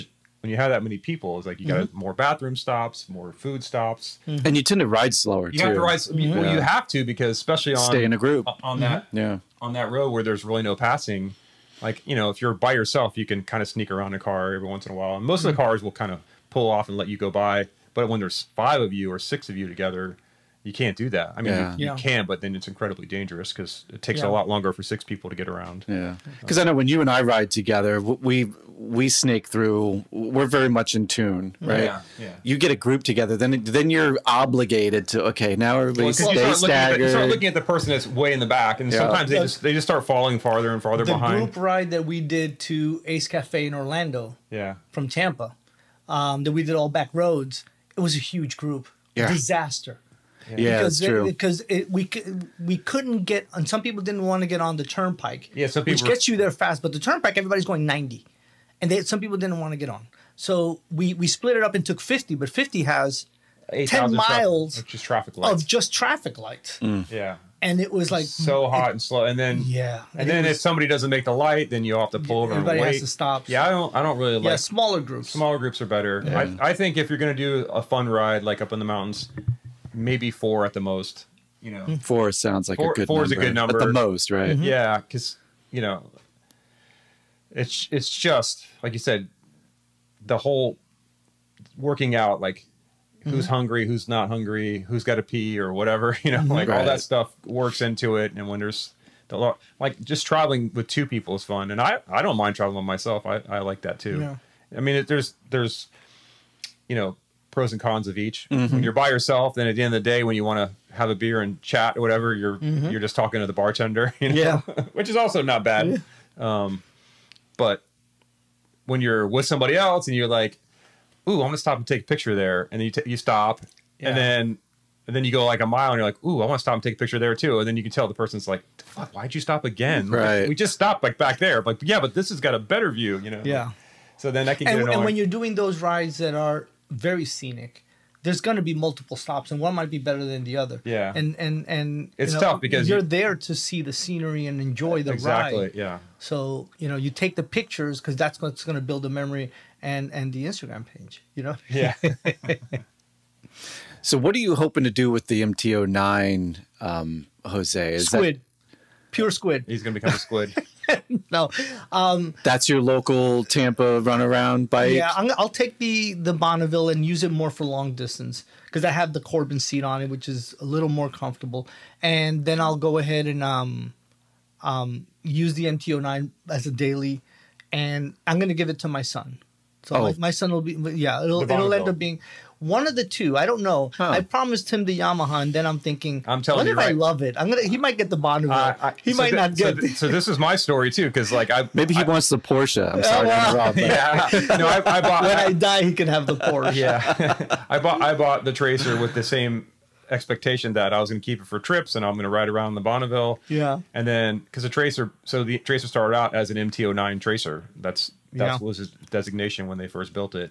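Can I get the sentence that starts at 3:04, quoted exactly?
I promised him the Yamaha, and then I'm thinking, I'm telling what you, if right.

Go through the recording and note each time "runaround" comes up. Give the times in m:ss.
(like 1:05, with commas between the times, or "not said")
2:44.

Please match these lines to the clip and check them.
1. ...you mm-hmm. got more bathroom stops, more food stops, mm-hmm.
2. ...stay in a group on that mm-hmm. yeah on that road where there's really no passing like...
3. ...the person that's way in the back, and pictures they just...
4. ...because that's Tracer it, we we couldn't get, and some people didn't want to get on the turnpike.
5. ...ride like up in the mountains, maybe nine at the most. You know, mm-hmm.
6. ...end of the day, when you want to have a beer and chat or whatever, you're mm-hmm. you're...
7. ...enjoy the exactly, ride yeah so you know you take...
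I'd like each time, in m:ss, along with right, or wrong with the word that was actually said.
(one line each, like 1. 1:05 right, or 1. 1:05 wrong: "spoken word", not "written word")
1. 0:01 right
2. 0:07 right
3. 0:37 wrong: "sometimes", not "pictures"
4. 0:50 wrong: "Because", not "Tracer"
5. 1:18 wrong: "four", not "nine"
6. 1:49 right
7. 2:24 right.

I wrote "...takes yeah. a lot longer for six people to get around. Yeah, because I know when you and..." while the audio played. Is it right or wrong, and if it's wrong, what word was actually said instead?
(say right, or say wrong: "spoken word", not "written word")
right.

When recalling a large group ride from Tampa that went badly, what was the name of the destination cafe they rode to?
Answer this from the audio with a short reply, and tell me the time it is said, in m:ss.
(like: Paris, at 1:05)
Ace Cafe, at 0:43.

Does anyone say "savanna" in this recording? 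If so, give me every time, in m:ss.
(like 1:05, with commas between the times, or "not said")
not said.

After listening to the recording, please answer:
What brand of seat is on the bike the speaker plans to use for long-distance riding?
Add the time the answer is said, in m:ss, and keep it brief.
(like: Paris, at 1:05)
Corbin, at 2:49.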